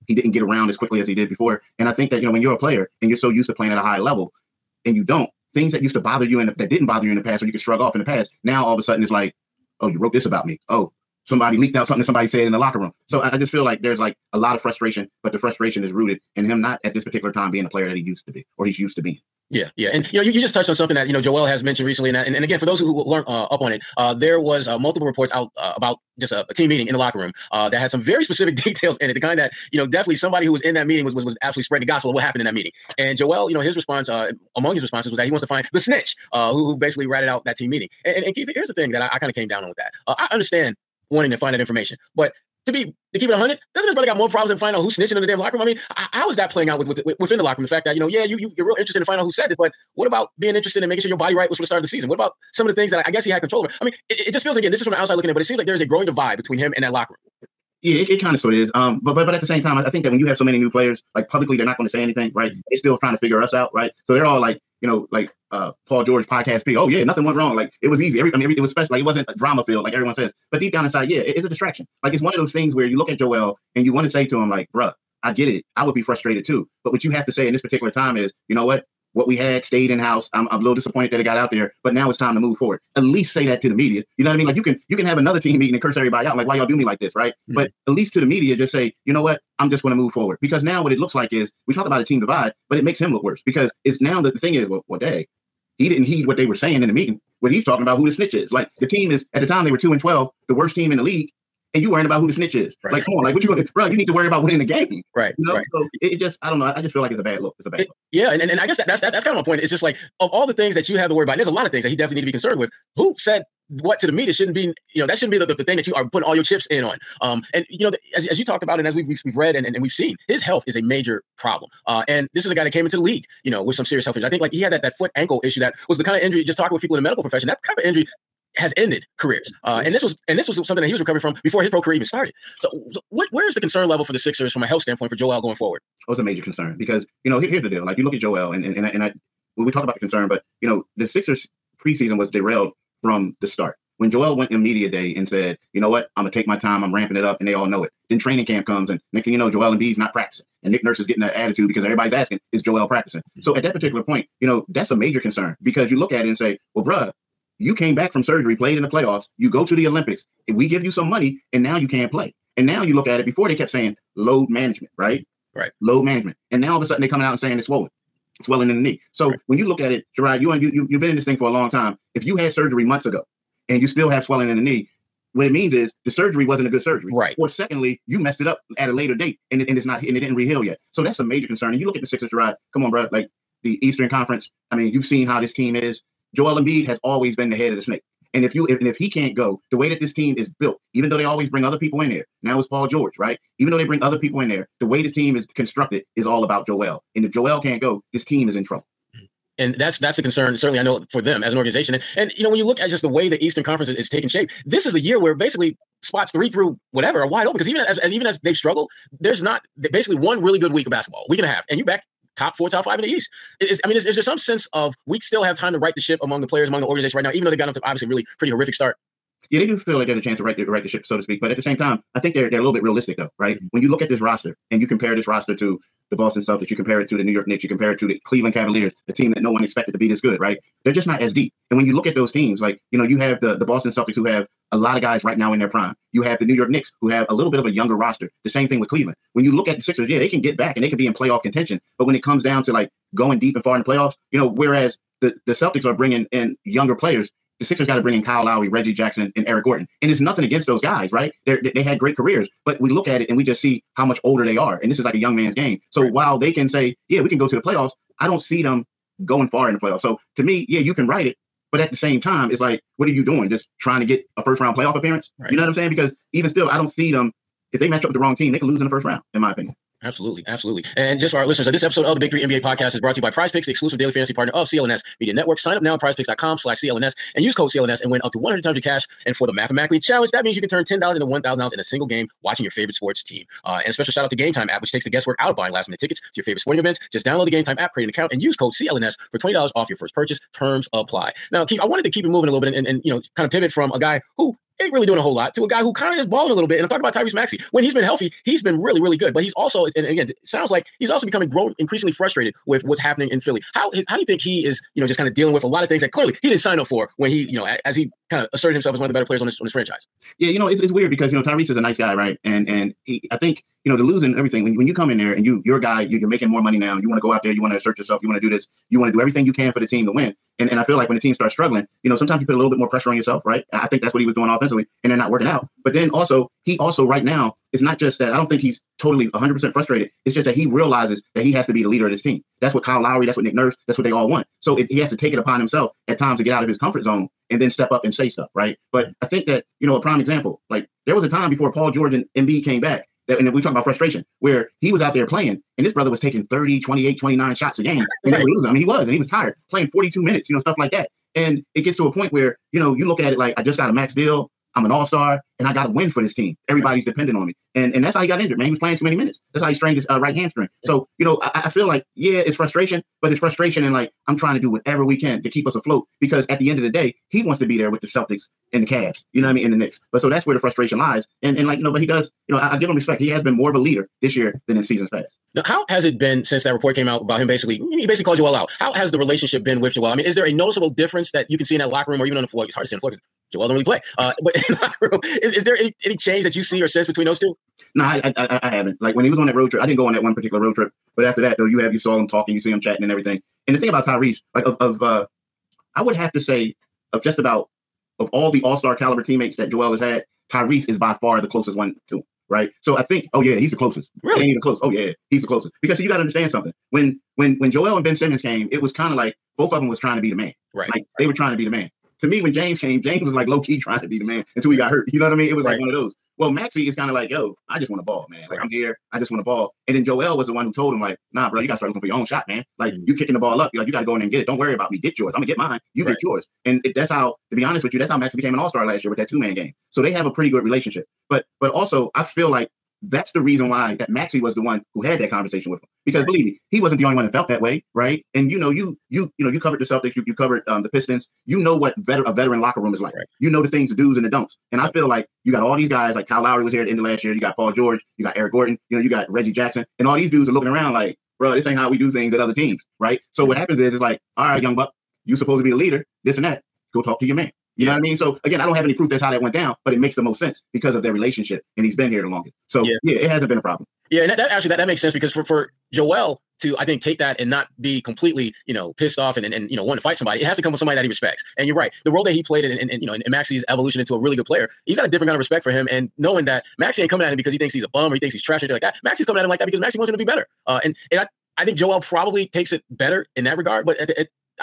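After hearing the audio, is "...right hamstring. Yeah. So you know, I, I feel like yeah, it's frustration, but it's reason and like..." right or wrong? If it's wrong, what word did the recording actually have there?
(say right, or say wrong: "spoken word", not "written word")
wrong: "frustration", not "reason".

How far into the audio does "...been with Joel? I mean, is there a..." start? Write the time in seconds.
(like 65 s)
379 s.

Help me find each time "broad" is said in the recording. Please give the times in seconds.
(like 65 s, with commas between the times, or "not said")
not said.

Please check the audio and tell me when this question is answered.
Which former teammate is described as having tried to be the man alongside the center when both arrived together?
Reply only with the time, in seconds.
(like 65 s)
408 s.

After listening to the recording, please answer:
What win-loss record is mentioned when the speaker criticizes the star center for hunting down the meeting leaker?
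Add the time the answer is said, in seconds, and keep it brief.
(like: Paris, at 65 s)
2-12, at 99 s.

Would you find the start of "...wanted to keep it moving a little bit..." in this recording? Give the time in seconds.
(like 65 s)
291 s.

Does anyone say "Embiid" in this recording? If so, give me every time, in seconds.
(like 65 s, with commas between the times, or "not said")
149 s, 186 s, 342 s.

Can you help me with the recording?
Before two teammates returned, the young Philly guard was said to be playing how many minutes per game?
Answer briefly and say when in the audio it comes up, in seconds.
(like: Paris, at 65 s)
42, at 349 s.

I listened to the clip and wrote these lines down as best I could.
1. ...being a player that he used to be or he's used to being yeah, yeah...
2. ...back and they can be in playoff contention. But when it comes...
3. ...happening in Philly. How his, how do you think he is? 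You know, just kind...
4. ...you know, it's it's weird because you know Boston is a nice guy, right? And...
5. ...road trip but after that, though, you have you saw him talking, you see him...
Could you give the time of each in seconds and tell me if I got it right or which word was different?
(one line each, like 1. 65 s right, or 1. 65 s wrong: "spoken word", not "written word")
1. 17 s right
2. 240 s right
3. 302 s right
4. 310 s wrong: "Tyrese", not "Boston"
5. 390 s right.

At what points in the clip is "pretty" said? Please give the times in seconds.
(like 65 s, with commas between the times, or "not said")
218 s, 430 s.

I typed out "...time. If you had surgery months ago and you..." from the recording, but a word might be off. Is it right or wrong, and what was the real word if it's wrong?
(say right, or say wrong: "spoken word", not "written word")
right.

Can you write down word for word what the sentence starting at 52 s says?
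What about some of the things that I, I guess he had control over?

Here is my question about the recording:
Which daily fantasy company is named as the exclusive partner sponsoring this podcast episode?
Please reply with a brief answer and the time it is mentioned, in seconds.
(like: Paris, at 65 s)
Prize Picks, at 273 s.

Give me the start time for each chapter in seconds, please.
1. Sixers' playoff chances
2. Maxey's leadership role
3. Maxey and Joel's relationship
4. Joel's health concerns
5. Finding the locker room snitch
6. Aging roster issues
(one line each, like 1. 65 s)
1. 198 s
2. 355 s
3. 429 s
4. 135 s
5. 39 s
6. 260 s.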